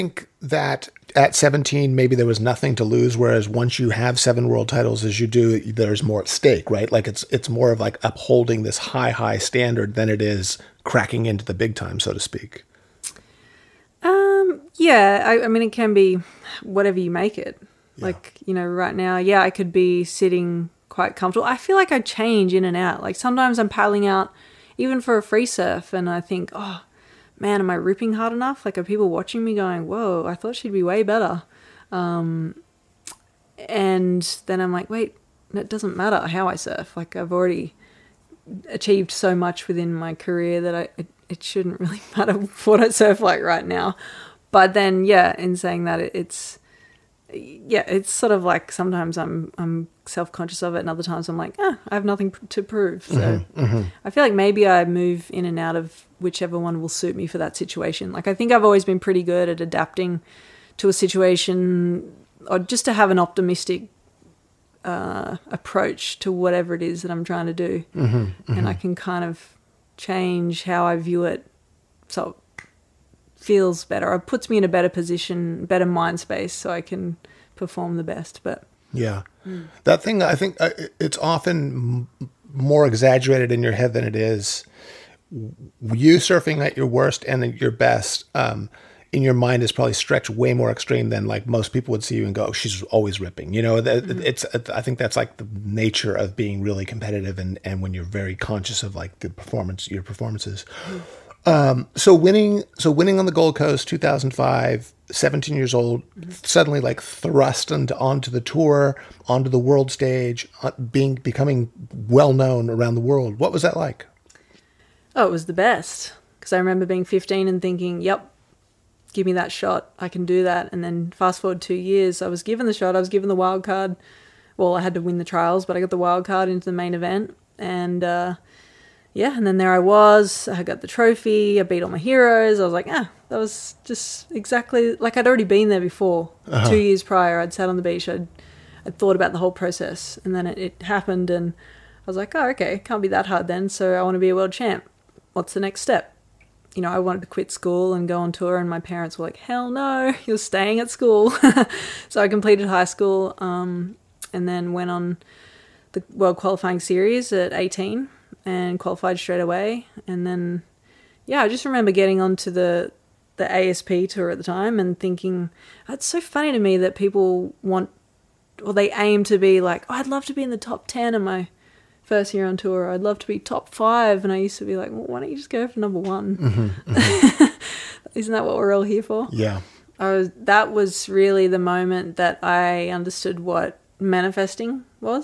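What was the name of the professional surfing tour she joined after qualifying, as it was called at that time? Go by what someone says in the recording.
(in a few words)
ASP tour.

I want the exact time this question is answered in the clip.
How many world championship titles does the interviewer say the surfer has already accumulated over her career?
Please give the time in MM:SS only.
00:04.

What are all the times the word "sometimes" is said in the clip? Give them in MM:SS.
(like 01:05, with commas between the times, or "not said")
00:23, 00:48.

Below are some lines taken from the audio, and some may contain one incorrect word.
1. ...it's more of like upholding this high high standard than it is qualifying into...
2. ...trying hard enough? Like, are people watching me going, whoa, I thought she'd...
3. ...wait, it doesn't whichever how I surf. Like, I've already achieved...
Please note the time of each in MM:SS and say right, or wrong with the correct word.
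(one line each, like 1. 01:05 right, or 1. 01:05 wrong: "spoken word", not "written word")
1. 00:07 wrong: "cracking", not "qualifying"
2. 00:27 wrong: "ripping", not "trying"
3. 00:34 wrong: "matter", not "whichever".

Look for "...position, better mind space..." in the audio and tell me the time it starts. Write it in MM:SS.
01:14.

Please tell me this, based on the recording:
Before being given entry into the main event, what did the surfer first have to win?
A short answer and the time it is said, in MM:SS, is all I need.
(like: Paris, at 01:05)
The trials, at 02:05.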